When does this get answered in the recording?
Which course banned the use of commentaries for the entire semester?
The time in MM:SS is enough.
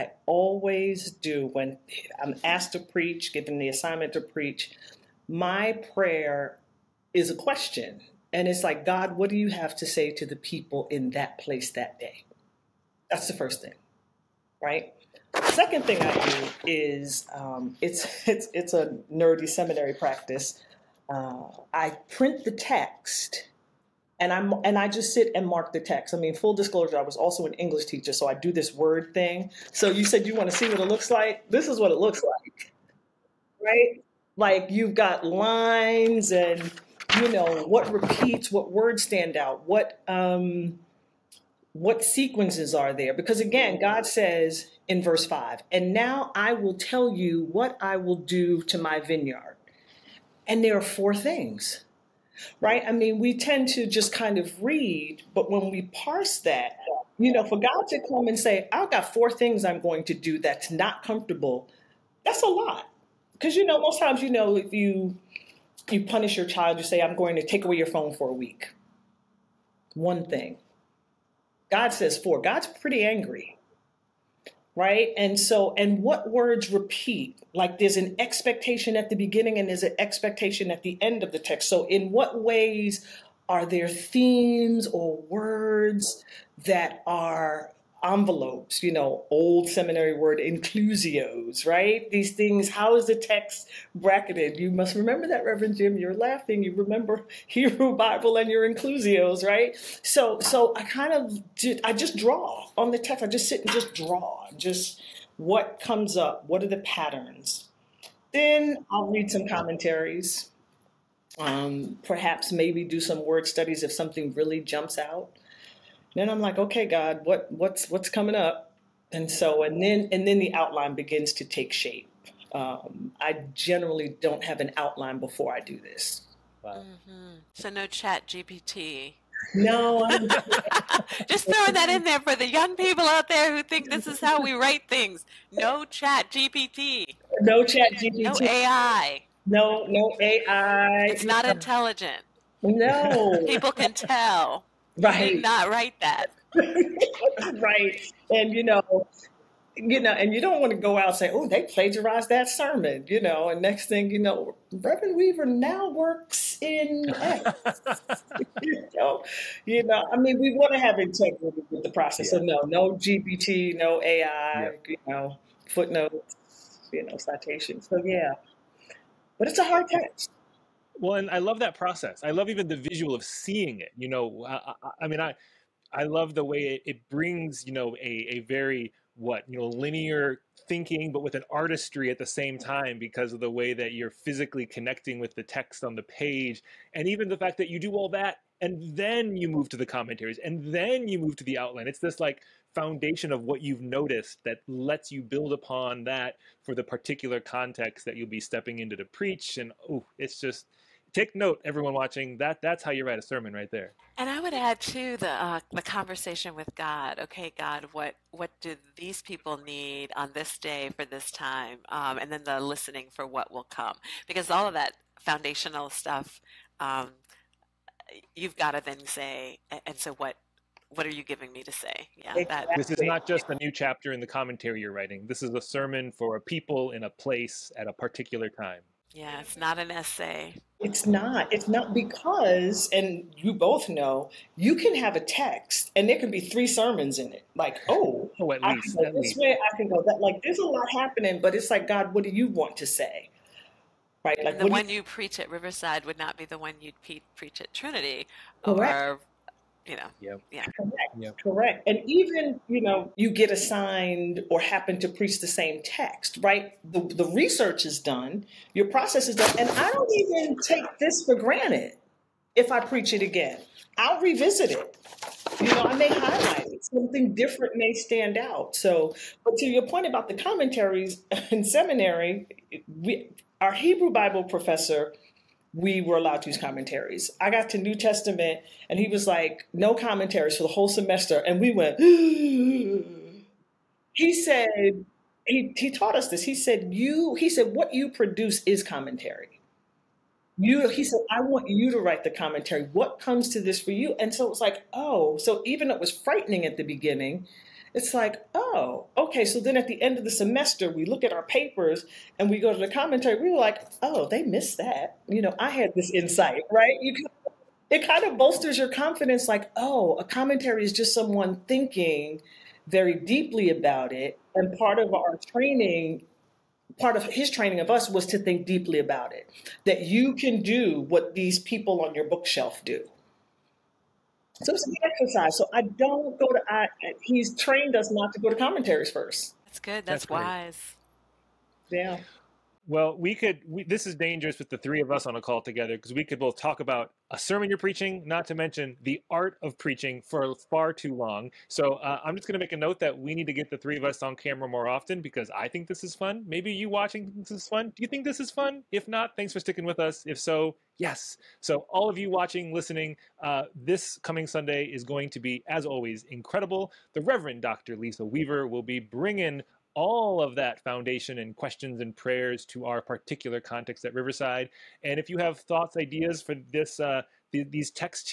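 04:37.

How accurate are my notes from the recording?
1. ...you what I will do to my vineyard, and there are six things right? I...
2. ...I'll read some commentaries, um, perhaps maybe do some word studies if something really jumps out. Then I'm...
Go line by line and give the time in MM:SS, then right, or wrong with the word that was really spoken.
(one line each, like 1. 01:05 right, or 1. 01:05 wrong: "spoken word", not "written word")
1. 00:47 wrong: "four", not "six"
2. 01:48 right.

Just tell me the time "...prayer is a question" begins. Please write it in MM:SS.
00:05.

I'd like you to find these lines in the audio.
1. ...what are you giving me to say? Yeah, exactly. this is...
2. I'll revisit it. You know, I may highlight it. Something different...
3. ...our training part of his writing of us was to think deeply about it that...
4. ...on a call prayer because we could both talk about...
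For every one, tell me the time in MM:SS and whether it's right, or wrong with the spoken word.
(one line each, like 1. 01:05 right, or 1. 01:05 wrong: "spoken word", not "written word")
1. 03:40 right
2. 04:23 right
3. 05:15 wrong: "training", not "writing"
4. 05:35 wrong: "together", not "prayer".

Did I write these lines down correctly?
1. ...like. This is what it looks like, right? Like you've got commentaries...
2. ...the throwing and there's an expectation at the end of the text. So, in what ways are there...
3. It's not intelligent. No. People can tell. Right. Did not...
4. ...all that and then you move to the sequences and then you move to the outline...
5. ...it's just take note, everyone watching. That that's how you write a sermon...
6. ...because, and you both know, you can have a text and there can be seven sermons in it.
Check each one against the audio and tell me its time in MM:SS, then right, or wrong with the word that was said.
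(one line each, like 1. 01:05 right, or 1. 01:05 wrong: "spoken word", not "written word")
1. 00:31 wrong: "lines", not "commentaries"
2. 01:19 wrong: "beginning", not "throwing"
3. 02:21 right
4. 03:07 wrong: "commentaries", not "sequences"
5. 03:20 right
6. 03:51 wrong: "three", not "seven".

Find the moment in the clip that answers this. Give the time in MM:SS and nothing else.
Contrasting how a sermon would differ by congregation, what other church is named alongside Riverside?
04:07.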